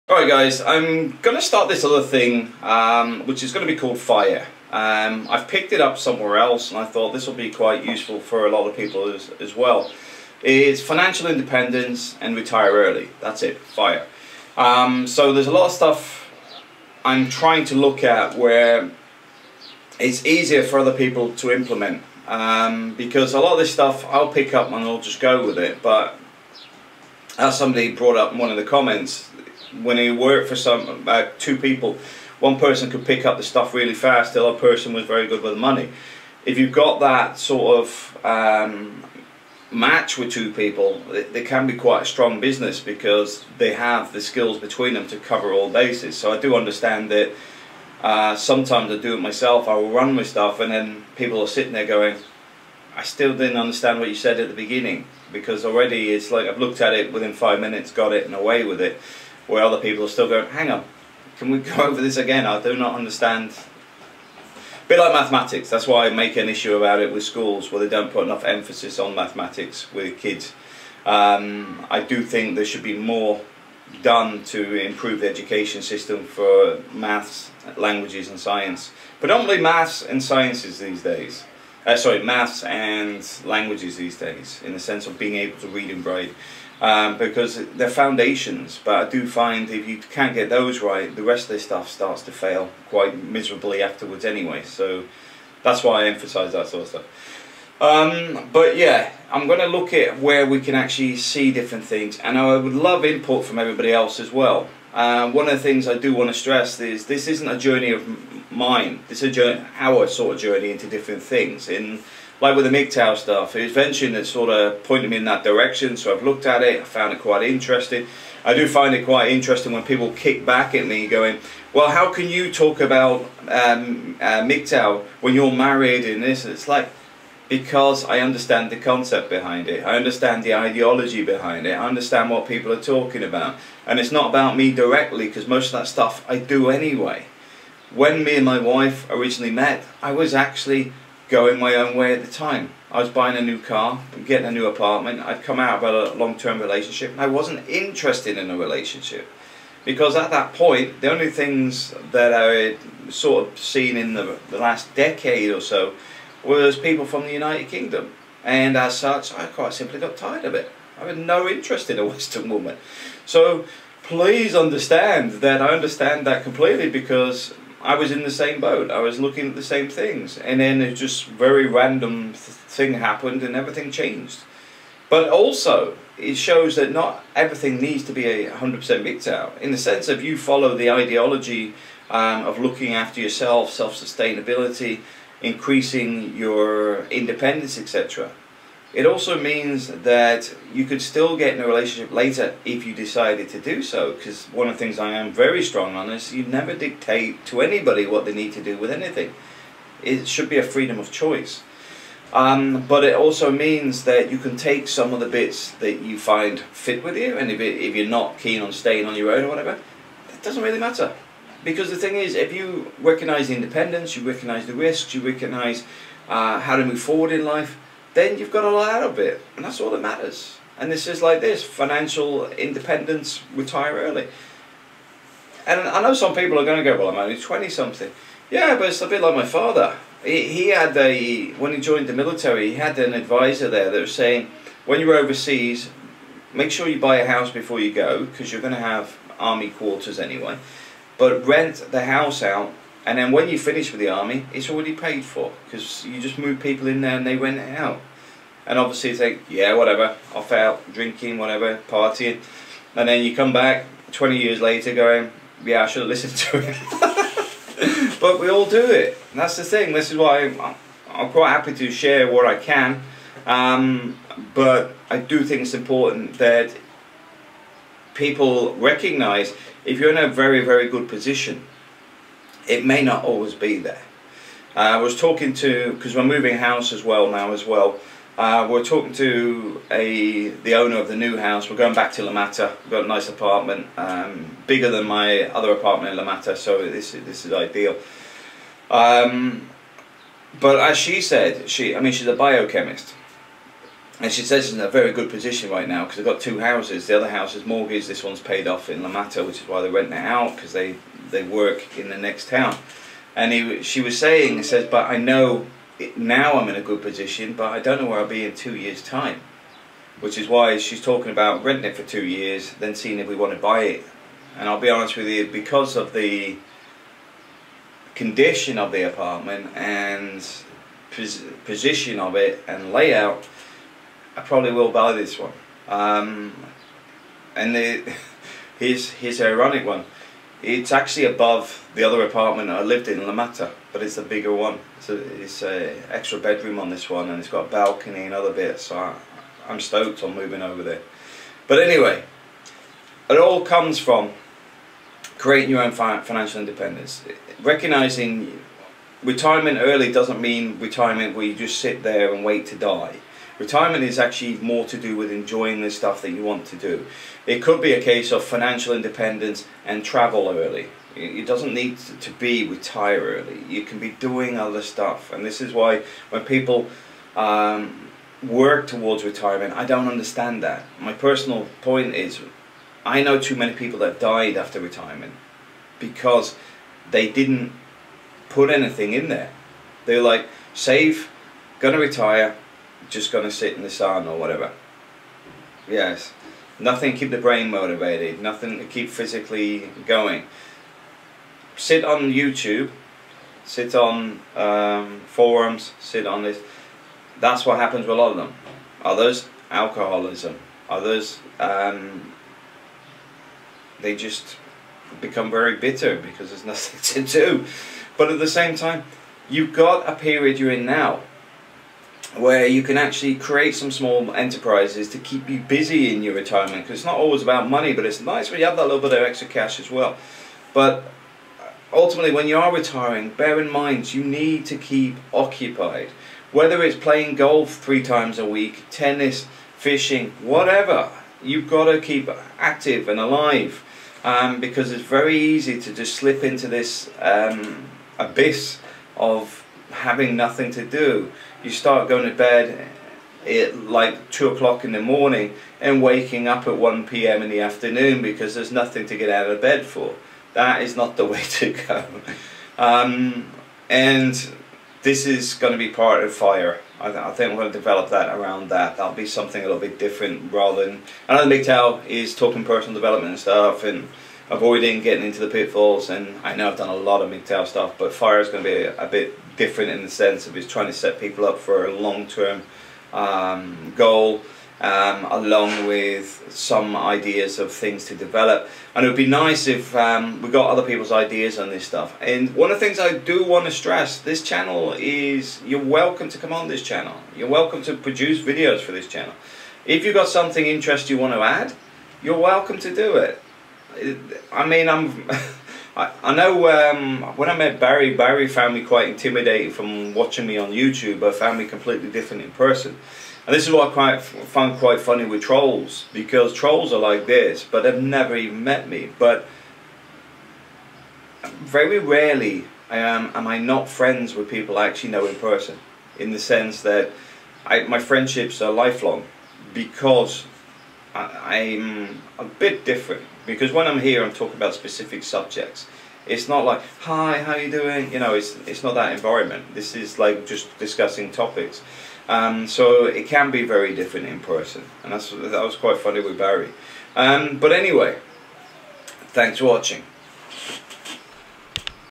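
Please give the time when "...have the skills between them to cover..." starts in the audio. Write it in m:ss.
0:43.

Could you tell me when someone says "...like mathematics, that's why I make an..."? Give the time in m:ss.
1:04.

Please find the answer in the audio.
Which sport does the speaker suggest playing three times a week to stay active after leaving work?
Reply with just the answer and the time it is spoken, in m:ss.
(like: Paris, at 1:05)
Golf, at 7:07.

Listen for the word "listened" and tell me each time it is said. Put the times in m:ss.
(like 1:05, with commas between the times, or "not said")
4:16.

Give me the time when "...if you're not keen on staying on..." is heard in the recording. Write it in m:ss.
3:27.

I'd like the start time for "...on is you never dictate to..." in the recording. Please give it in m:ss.
3:15.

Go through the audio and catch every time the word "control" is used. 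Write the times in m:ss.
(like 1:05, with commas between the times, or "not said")
not said.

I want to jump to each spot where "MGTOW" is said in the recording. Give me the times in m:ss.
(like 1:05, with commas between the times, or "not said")
1:52, 2:04, 7:47.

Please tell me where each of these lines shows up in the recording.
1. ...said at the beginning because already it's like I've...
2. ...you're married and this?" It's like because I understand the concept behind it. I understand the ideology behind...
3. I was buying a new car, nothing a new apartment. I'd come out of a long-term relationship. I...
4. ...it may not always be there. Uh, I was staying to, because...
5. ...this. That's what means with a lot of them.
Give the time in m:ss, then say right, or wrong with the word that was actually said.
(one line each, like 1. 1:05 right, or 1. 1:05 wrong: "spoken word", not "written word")
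1. 0:54 right
2. 2:05 right
3. 2:22 wrong: "getting", not "nothing"
4. 4:32 wrong: "talking", not "staying"
5. 6:36 wrong: "happens", not "means".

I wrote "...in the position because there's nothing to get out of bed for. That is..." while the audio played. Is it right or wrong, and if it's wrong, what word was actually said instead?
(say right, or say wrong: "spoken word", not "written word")
wrong: "afternoon", not "position".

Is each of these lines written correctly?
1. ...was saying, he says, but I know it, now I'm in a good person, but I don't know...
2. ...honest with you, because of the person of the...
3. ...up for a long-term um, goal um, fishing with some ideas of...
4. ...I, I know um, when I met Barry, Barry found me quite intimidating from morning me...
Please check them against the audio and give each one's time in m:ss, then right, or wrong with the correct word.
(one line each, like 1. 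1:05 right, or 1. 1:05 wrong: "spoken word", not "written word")
1. 5:04 wrong: "position", not "person"
2. 5:14 wrong: "condition", not "person"
3. 7:51 wrong: "along", not "fishing"
4. 8:15 wrong: "watching", not "morning".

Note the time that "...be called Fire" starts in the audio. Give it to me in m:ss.
0:03.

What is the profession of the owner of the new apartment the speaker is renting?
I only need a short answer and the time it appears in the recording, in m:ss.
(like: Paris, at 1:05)
Biochemist, at 4:52.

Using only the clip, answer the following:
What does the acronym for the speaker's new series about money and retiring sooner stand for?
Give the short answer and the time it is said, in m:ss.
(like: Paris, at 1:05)
Financial independence and retire early, at 0:10.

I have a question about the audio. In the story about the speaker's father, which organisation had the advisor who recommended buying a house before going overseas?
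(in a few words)
The military.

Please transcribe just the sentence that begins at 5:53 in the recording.
Retirement is actually more to do with enjoying the stuff that you want to do.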